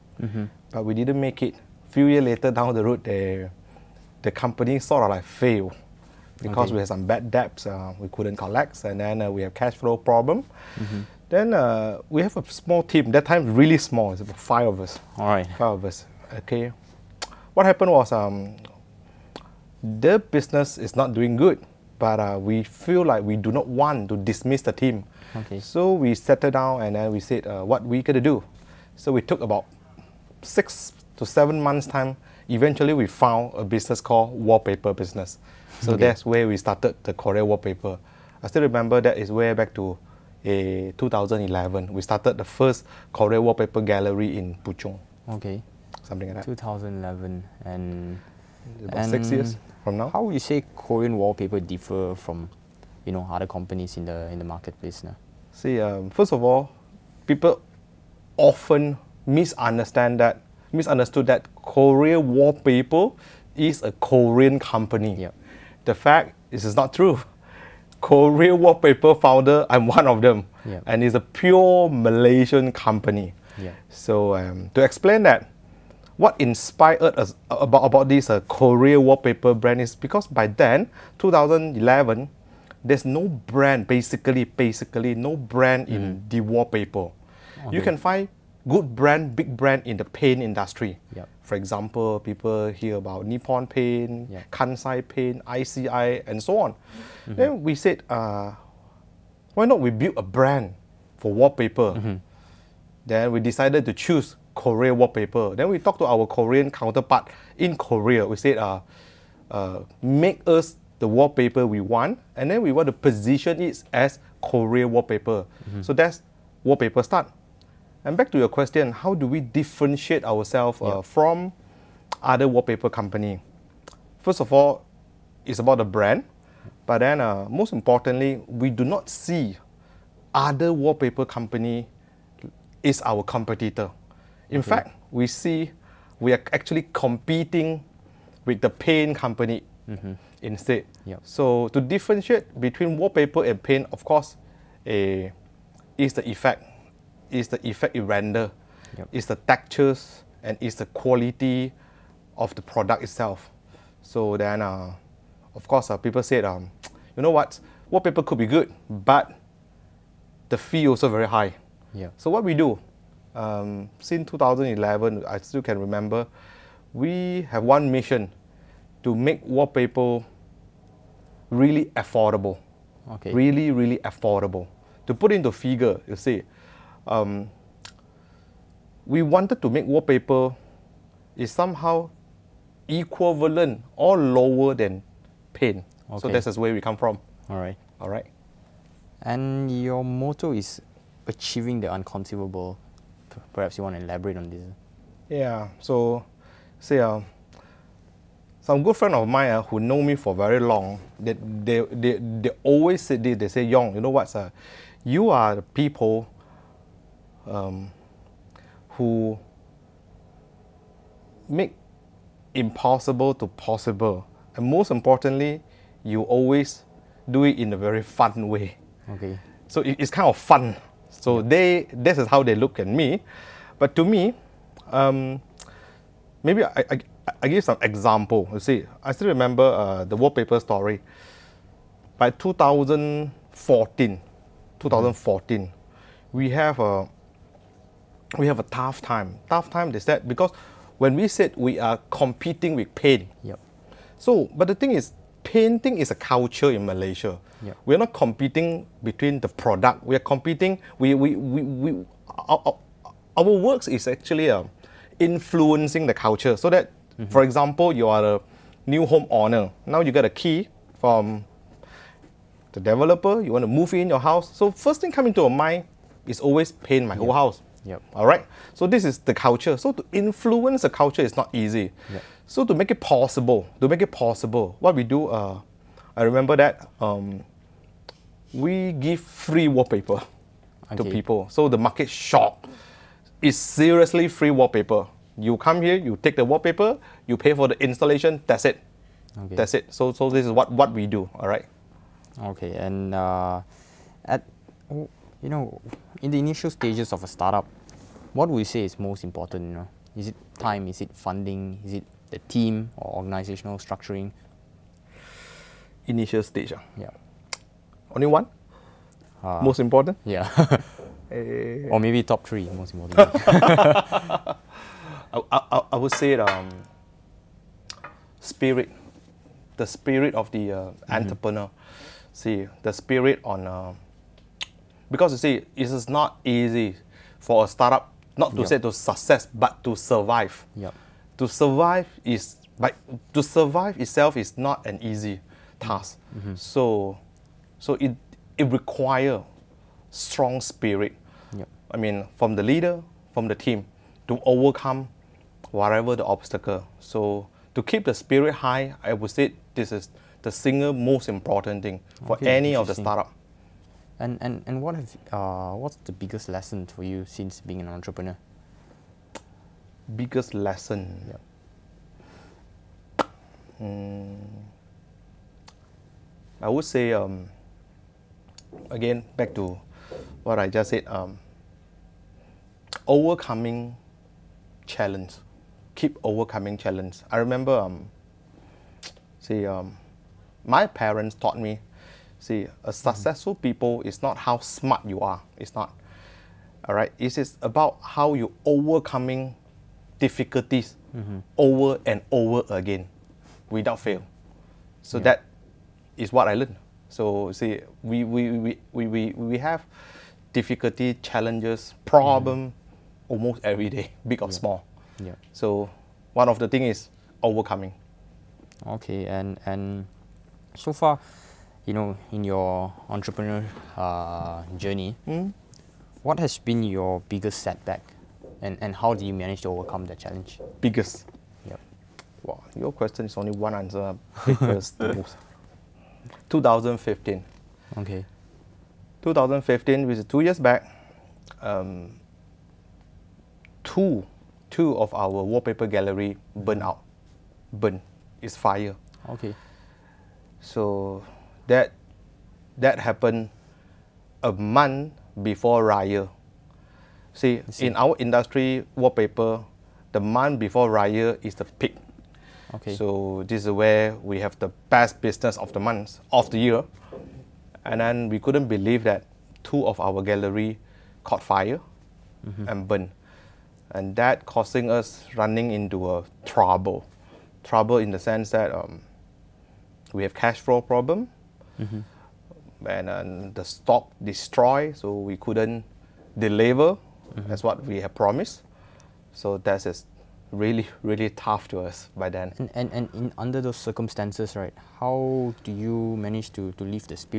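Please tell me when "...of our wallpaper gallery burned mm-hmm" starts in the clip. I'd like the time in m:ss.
7:14.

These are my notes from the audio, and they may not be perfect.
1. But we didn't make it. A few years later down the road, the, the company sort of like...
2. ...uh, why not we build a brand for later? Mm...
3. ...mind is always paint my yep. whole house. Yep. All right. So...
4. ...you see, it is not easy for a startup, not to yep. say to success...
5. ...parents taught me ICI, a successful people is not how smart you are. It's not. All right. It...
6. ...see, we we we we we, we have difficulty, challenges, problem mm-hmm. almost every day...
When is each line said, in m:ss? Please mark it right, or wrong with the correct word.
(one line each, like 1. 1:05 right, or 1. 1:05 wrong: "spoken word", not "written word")
1. 0:00 right
2. 1:38 wrong: "wallpaper", not "later"
3. 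4:25 right
4. 5:25 right
5. 6:20 wrong: "See", not "ICI"
6. 6:37 right.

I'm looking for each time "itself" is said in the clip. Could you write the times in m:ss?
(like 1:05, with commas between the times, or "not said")
2:33, 5:34.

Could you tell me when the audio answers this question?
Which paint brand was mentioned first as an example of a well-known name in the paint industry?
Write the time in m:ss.
1:33.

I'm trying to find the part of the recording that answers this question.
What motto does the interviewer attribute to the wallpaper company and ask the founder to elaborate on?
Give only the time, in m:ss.
3:11.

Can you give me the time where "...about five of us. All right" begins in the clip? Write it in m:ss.
0:14.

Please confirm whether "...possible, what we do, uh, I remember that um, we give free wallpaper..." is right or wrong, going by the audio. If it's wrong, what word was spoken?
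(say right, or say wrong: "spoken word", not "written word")
right.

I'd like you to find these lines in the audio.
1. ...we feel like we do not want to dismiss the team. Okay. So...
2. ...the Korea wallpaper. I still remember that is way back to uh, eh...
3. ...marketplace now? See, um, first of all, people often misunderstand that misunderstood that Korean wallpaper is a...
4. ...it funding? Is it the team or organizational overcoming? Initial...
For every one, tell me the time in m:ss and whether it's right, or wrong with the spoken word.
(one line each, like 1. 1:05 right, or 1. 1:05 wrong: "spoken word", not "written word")
1. 0:22 right
2. 0:37 right
3. 0:54 right
4. 5:01 wrong: "structuring", not "overcoming".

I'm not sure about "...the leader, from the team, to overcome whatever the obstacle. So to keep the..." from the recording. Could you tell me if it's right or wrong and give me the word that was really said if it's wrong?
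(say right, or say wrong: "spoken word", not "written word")
right.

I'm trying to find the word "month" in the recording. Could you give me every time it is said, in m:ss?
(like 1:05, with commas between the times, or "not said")
0:31, 7:24, 7:30, 7:35.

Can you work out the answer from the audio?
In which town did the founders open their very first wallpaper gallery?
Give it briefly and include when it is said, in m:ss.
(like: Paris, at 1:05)
Puchong, at 0:44.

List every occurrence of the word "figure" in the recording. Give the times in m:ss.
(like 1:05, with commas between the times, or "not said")
2:55.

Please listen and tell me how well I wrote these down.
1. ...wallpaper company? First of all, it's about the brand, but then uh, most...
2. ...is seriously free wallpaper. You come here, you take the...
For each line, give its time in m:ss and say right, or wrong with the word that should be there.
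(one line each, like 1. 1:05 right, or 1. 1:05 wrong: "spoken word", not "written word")
1. 2:02 right
2. 4:43 right.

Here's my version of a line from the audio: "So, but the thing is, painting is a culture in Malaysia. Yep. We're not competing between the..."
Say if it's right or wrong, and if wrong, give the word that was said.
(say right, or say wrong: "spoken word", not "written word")
right.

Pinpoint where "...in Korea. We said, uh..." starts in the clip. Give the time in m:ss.
1:47.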